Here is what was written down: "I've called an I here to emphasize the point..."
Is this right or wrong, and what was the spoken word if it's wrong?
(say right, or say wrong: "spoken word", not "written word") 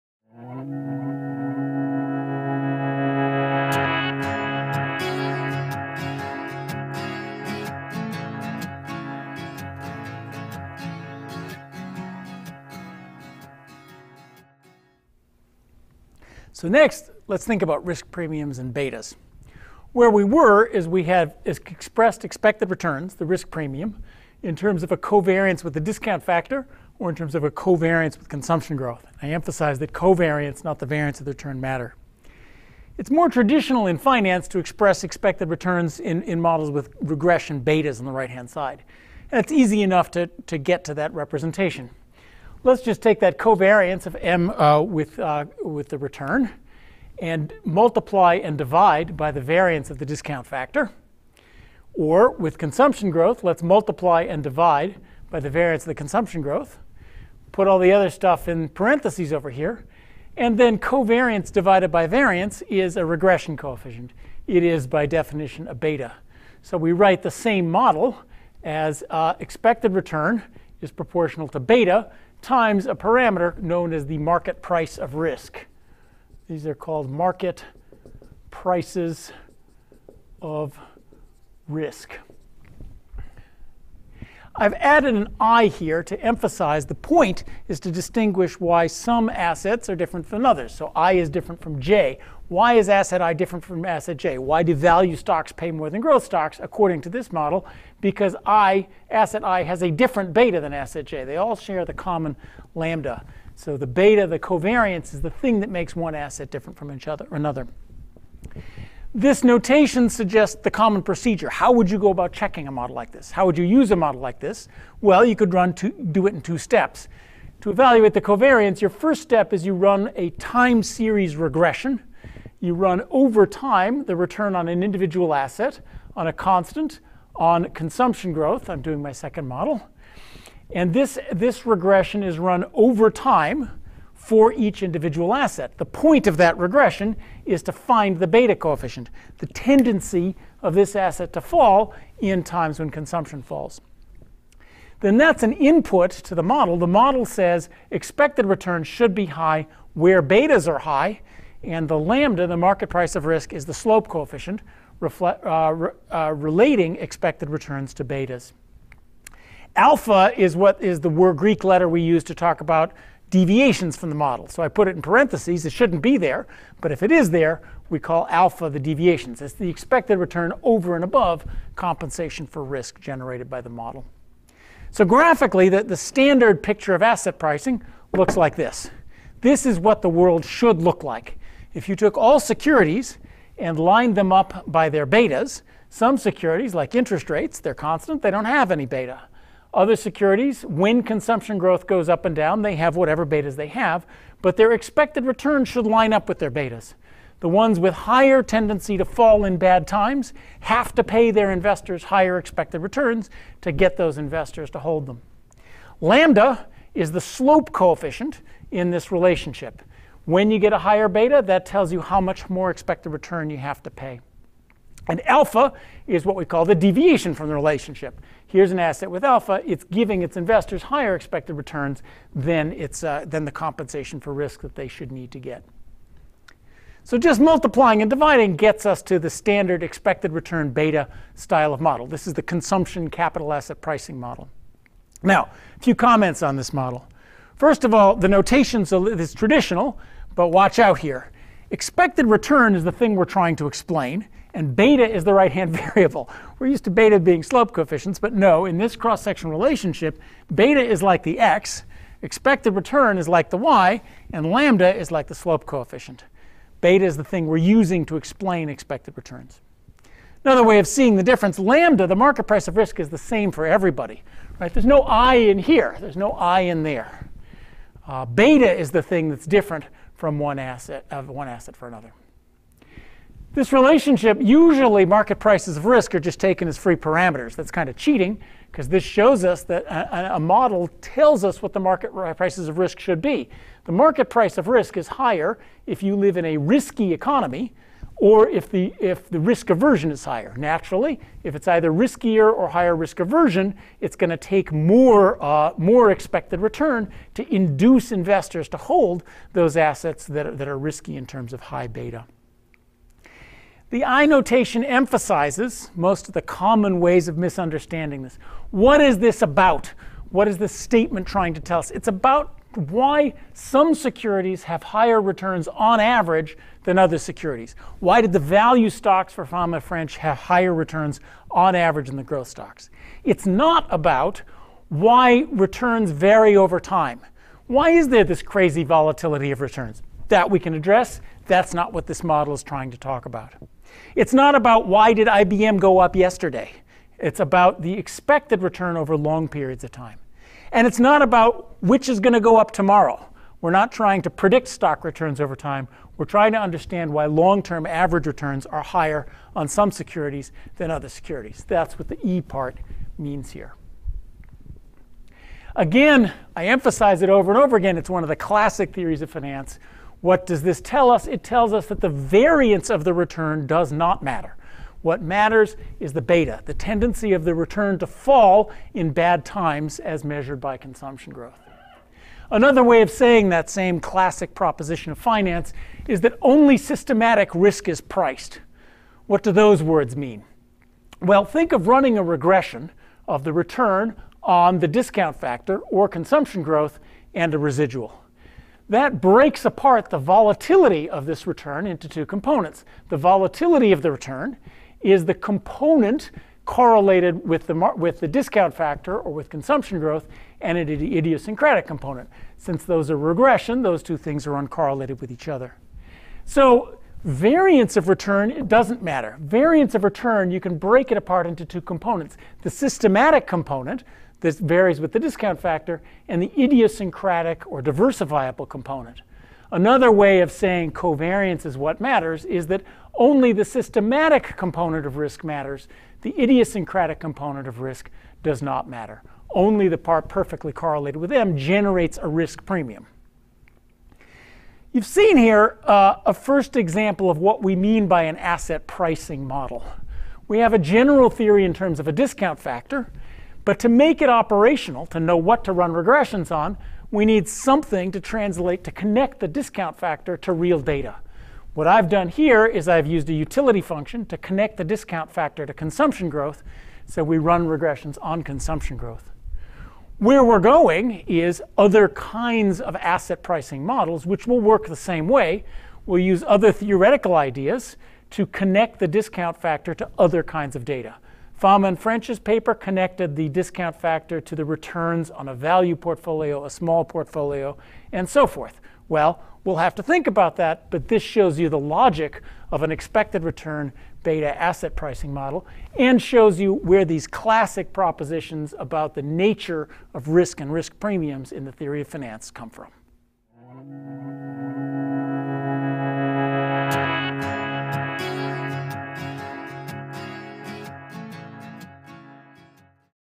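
wrong: "added", not "called".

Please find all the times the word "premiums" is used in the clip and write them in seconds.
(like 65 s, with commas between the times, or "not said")
18 s, 23 s, 432 s, 490 s.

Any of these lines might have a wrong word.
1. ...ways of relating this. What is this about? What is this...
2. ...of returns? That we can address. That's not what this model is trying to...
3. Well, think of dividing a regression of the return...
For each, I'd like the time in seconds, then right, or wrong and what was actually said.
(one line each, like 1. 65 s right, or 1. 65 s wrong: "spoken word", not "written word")
1. 307 s wrong: "misunderstanding", not "relating"
2. 329 s right
3. 381 s wrong: "running", not "dividing".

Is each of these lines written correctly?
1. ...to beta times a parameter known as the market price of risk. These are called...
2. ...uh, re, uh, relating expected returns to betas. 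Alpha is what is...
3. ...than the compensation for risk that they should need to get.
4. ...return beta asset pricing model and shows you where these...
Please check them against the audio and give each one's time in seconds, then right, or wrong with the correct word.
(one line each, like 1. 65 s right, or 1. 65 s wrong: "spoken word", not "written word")
1. 71 s right
2. 155 s right
3. 223 s right
4. 483 s right.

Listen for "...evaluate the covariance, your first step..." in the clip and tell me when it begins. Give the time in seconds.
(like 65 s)
117 s.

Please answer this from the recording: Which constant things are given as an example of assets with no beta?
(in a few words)
interest rates.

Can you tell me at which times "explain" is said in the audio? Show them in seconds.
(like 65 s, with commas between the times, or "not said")
243 s, 258 s.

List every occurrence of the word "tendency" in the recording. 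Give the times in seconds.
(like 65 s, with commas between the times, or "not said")
139 s, 198 s, 366 s.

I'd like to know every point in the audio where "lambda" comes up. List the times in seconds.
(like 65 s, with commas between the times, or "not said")
102 s, 151 s, 206 s, 254 s, 261 s.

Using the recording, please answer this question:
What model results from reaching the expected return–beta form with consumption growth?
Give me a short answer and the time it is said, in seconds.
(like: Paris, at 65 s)
consumption capital asset pricing model, at 232 s.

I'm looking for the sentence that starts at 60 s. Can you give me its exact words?
And then covariance divided by variance is a regression coefficient.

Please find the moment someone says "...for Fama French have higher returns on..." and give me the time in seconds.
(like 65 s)
319 s.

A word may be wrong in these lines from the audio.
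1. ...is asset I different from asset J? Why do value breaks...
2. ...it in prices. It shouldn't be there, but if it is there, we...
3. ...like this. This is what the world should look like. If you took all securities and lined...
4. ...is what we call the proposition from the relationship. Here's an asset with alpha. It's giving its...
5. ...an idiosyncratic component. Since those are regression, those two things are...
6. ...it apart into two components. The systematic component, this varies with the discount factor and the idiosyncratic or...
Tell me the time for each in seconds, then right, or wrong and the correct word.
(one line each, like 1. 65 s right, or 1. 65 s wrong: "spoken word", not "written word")
1. 92 s wrong: "stocks", not "breaks"
2. 164 s wrong: "parentheses", not "prices"
3. 178 s right
4. 216 s wrong: "deviation", not "proposition"
5. 400 s right
6. 411 s right.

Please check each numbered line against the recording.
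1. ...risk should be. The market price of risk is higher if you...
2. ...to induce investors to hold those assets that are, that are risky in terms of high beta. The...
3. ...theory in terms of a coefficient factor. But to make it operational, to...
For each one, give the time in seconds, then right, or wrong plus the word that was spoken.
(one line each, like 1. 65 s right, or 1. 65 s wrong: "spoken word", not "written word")
1. 282 s right
2. 297 s right
3. 441 s wrong: "discount", not "coefficient".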